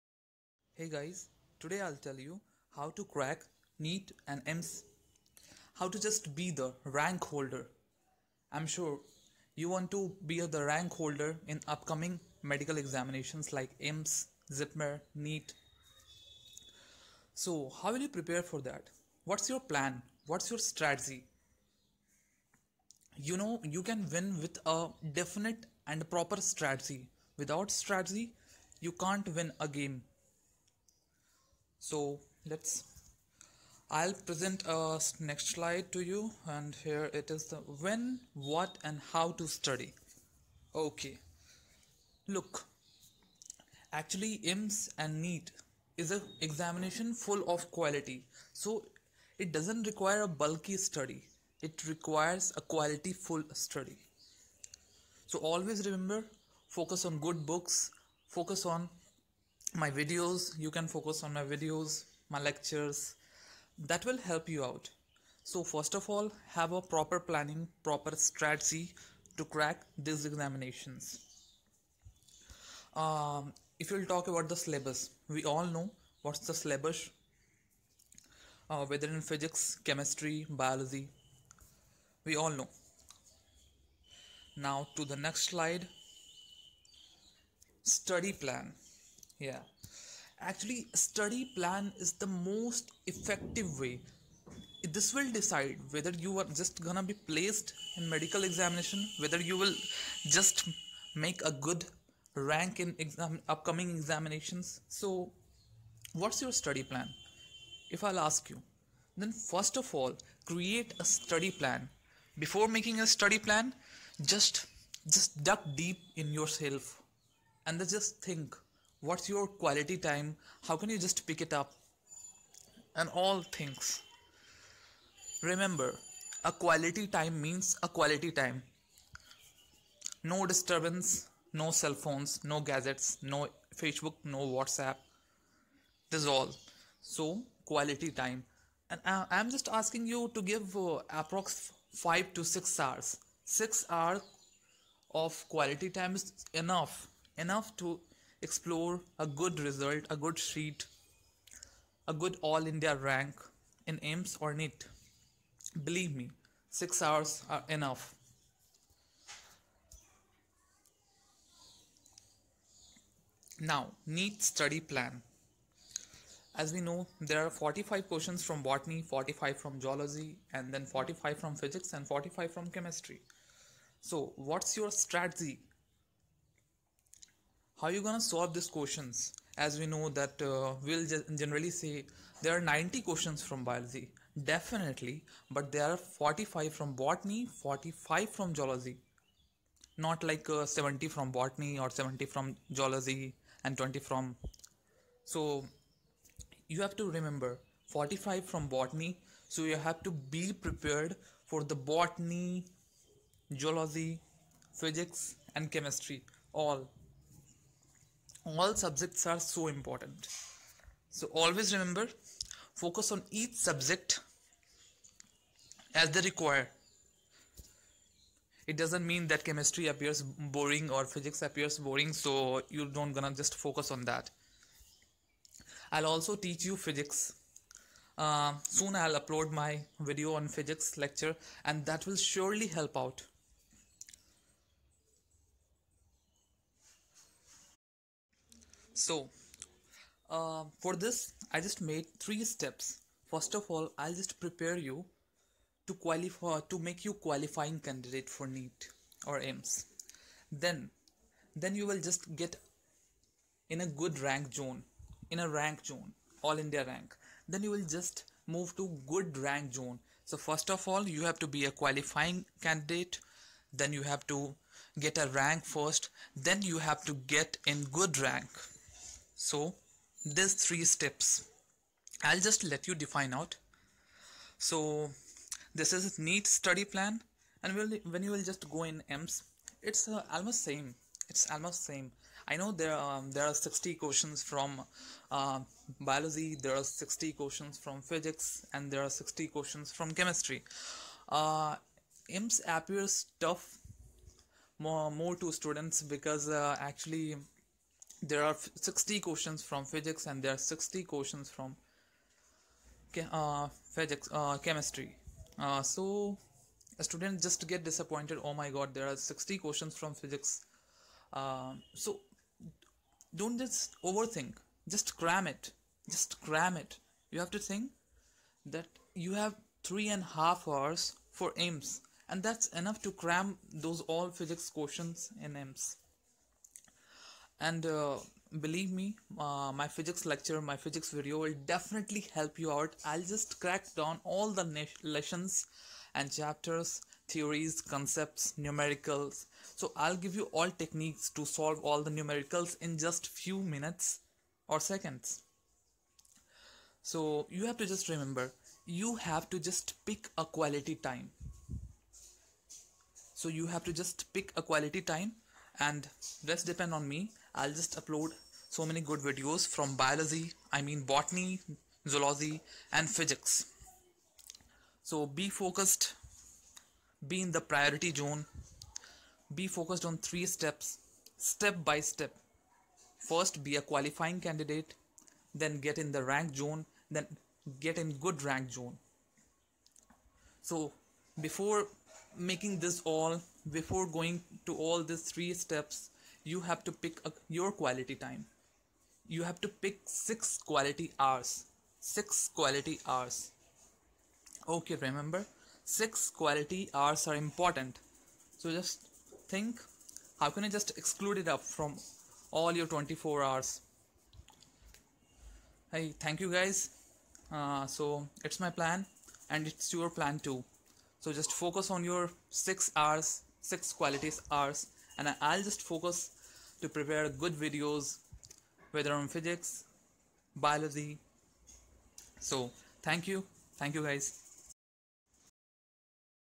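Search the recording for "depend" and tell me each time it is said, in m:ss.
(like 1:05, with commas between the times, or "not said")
5:56.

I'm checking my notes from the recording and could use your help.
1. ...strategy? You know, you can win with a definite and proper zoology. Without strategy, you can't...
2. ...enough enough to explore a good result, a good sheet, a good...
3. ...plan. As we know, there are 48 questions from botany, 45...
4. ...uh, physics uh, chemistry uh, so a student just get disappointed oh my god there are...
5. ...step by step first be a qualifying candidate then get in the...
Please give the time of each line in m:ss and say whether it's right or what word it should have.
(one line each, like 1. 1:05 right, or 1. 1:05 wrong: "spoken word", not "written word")
1. 0:20 wrong: "strategy", not "zoology"
2. 2:26 right
3. 2:44 wrong: "45", not "48"
4. 5:03 right
5. 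6:11 right.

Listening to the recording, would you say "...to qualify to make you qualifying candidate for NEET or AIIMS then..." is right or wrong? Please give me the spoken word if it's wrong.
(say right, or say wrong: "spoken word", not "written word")
right.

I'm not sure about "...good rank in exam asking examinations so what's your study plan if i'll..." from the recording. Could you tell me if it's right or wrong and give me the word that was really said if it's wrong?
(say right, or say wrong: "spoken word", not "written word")
wrong: "upcoming", not "asking".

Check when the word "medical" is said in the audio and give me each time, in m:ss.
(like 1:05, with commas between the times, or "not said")
0:12, 1:38.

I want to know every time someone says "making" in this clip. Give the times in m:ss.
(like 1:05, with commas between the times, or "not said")
1:52, 6:22.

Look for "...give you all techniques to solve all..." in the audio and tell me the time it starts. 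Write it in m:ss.
5:40.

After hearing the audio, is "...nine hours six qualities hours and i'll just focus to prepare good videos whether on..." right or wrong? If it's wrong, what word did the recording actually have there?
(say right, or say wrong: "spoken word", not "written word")
wrong: "six", not "nine".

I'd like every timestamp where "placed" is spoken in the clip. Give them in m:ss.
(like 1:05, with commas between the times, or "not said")
1:37.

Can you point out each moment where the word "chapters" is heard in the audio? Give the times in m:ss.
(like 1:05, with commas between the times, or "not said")
5:36.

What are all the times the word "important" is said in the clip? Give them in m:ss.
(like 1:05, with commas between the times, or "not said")
3:29, 6:37.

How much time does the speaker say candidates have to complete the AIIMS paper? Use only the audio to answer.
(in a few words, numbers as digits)
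three and a half hours.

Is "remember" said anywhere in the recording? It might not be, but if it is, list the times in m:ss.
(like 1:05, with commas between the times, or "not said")
0:55, 2:05, 3:17, 3:31, 5:48, 6:34.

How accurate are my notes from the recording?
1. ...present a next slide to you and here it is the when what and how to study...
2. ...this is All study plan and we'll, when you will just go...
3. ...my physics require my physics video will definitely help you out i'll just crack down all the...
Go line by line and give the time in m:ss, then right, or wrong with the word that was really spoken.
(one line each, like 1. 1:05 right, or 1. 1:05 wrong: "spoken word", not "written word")
1. 0:34 right
2. 4:35 wrong: "NEET", not "All"
3. 5:29 wrong: "lecture", not "require".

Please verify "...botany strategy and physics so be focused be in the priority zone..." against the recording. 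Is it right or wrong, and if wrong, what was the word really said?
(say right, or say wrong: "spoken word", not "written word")
wrong: "zoology", not "strategy".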